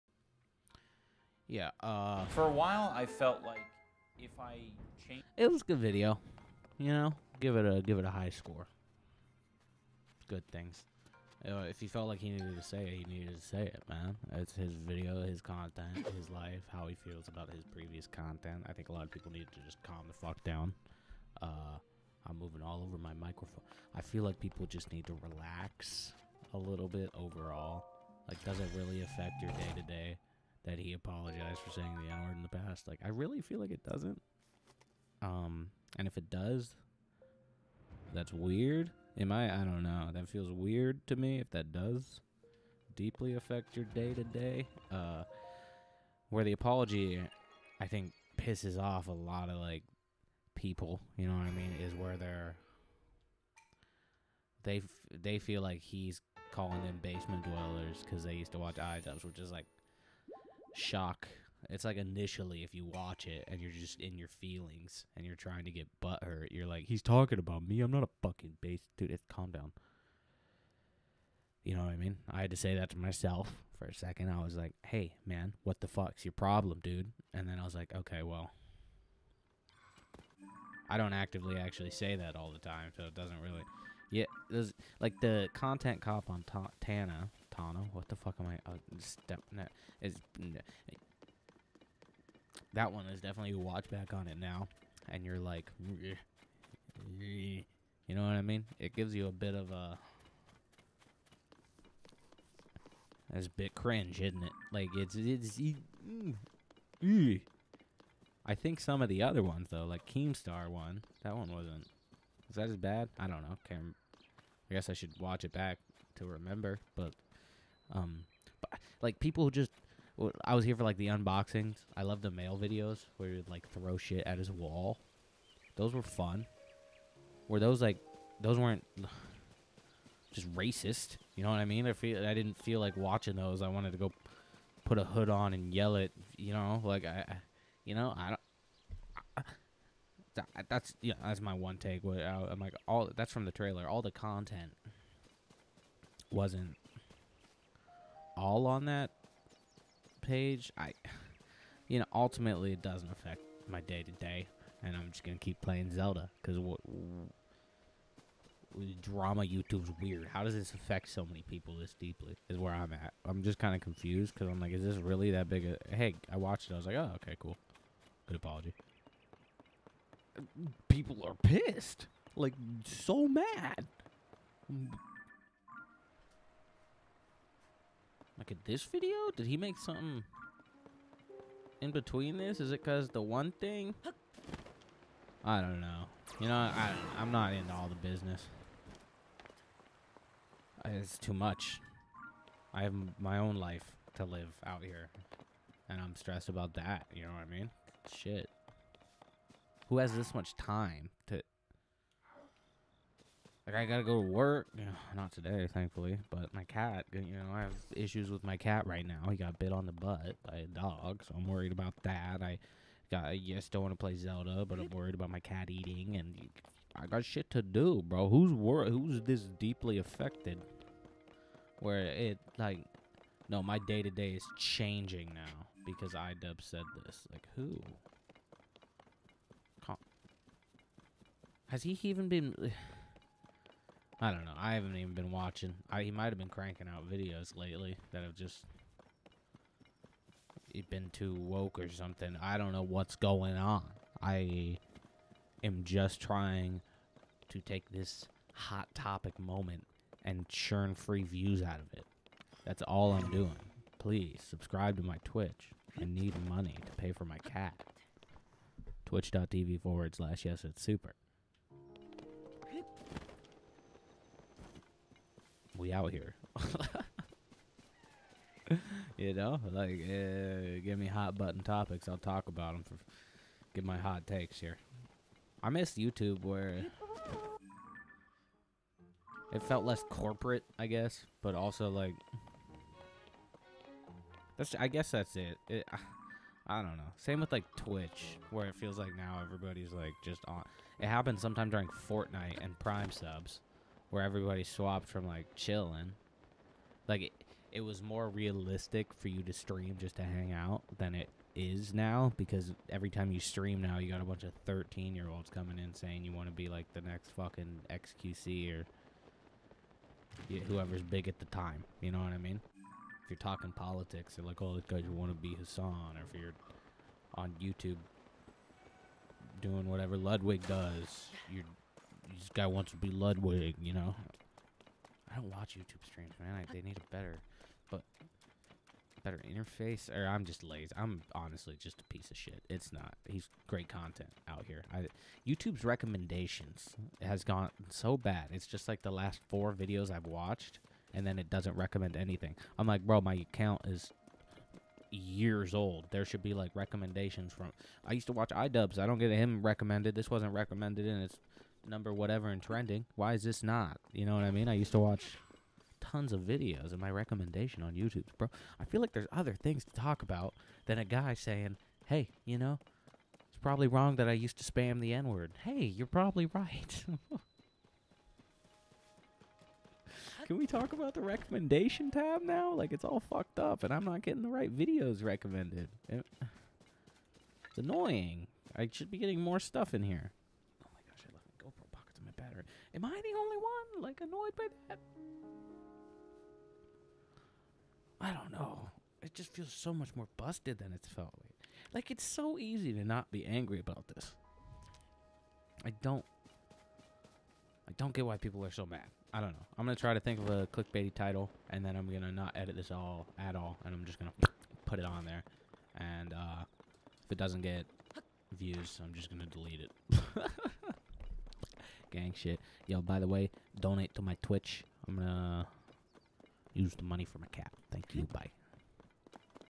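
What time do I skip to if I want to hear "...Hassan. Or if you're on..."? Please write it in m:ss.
5:15.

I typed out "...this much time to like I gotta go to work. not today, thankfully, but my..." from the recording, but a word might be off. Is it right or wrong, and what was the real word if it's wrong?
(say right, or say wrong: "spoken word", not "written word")
right.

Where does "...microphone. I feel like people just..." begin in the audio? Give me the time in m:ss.
0:23.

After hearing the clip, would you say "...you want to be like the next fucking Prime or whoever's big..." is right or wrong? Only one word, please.
wrong.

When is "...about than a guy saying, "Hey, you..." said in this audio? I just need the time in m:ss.
6:00.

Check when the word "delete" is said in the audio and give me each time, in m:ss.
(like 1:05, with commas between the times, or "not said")
6:49.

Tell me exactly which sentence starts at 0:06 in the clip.
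You know, give it a give it a high score.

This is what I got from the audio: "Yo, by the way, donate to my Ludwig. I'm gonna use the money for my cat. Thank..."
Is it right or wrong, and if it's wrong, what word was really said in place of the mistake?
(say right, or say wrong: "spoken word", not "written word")
wrong: "Twitch", not "Ludwig".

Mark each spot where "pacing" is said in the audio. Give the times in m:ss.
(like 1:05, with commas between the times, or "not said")
not said.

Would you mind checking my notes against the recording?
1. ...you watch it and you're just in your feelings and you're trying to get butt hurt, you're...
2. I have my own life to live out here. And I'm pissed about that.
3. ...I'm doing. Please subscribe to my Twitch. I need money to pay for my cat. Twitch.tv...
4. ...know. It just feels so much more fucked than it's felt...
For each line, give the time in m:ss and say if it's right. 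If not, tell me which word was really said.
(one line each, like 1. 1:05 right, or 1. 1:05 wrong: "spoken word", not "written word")
1. 1:02 right
2. 3:12 wrong: "stressed", not "pissed"
3. 4:13 right
4. 6:28 wrong: "busted", not "fucked".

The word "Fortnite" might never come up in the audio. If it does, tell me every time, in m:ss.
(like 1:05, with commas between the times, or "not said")
4:52.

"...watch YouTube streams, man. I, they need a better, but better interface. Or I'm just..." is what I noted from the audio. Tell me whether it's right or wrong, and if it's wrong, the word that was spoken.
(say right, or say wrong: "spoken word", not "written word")
right.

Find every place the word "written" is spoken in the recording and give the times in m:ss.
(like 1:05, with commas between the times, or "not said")
not said.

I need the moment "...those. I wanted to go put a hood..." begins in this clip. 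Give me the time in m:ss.
2:13.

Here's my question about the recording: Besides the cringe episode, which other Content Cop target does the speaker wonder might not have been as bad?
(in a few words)
Keemstar.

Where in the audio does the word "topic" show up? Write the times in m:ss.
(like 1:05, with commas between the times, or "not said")
4:08, 4:31.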